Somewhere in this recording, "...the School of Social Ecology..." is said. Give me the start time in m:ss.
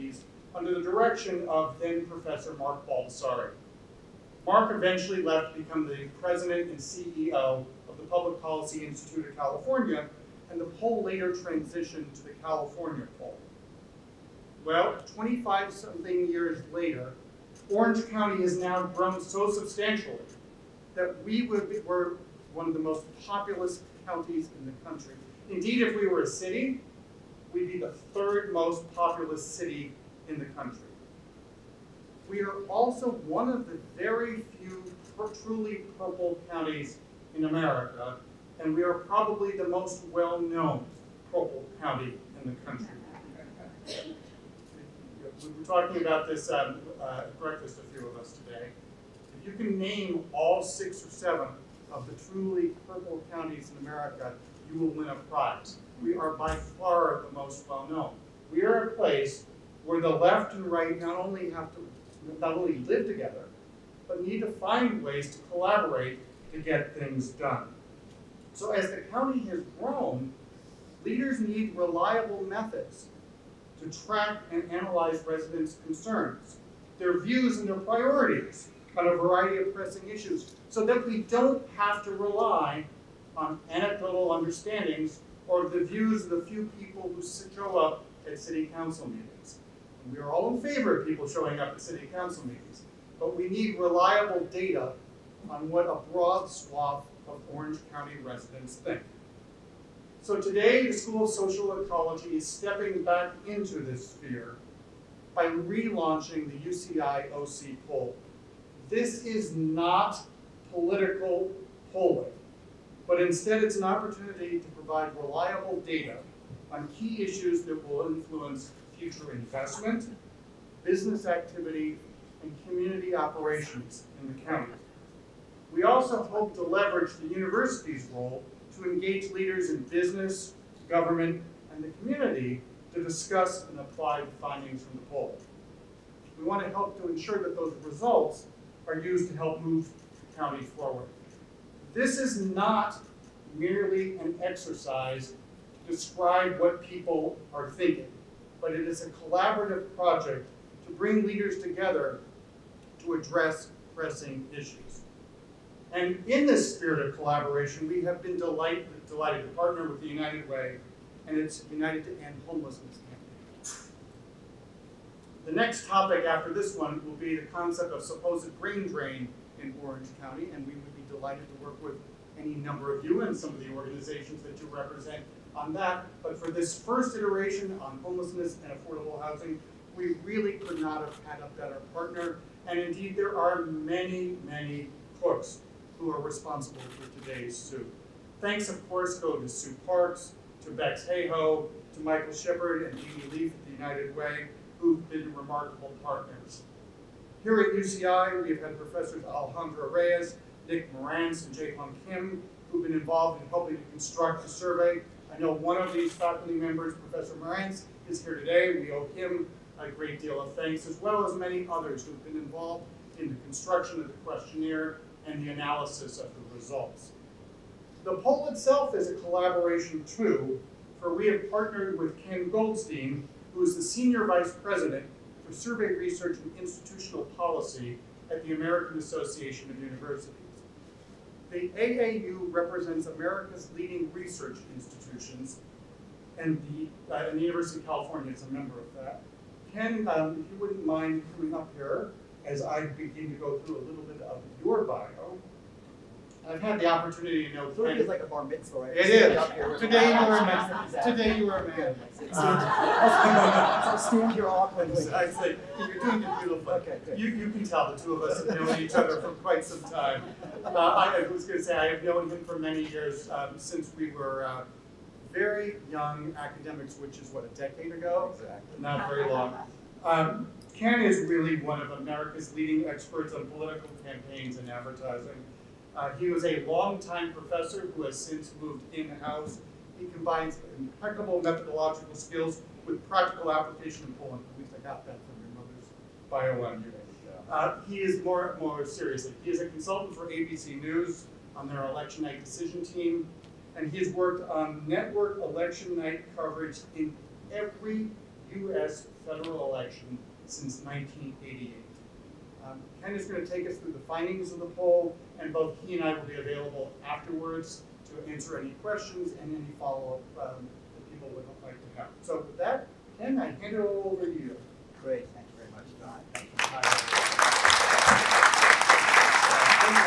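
1:40.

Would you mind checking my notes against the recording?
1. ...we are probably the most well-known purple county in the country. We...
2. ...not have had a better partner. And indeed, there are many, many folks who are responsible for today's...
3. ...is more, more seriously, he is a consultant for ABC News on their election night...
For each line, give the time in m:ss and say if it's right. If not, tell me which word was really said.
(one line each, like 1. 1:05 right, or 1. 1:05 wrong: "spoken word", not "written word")
1. 0:38 right
2. 3:00 right
3. 4:47 right.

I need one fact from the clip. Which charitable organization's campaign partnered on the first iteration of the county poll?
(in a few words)
United to End Homelessness.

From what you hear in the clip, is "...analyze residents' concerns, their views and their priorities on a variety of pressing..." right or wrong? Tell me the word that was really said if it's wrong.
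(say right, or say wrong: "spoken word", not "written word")
right.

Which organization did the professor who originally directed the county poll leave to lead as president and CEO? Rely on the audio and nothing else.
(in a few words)
Public Policy Institute of California.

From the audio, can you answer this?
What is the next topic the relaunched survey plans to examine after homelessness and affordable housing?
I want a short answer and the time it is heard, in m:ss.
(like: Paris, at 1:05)
brain drain, at 2:48.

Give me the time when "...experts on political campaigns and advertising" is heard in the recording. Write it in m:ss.
4:32.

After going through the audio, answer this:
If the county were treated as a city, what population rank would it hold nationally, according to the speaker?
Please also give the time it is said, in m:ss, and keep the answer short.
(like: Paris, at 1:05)
third, at 0:28.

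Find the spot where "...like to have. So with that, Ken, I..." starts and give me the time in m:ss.
5:11.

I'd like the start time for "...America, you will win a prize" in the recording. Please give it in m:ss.
0:53.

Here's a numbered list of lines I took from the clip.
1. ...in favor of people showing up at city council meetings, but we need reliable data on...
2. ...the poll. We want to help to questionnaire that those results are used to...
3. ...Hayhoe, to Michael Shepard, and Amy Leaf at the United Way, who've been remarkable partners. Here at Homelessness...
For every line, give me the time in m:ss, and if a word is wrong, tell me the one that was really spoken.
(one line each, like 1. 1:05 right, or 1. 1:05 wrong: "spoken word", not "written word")
1. 1:30 right
2. 2:14 wrong: "ensure", not "questionnaire"
3. 3:11 wrong: "UCI", not "Homelessness".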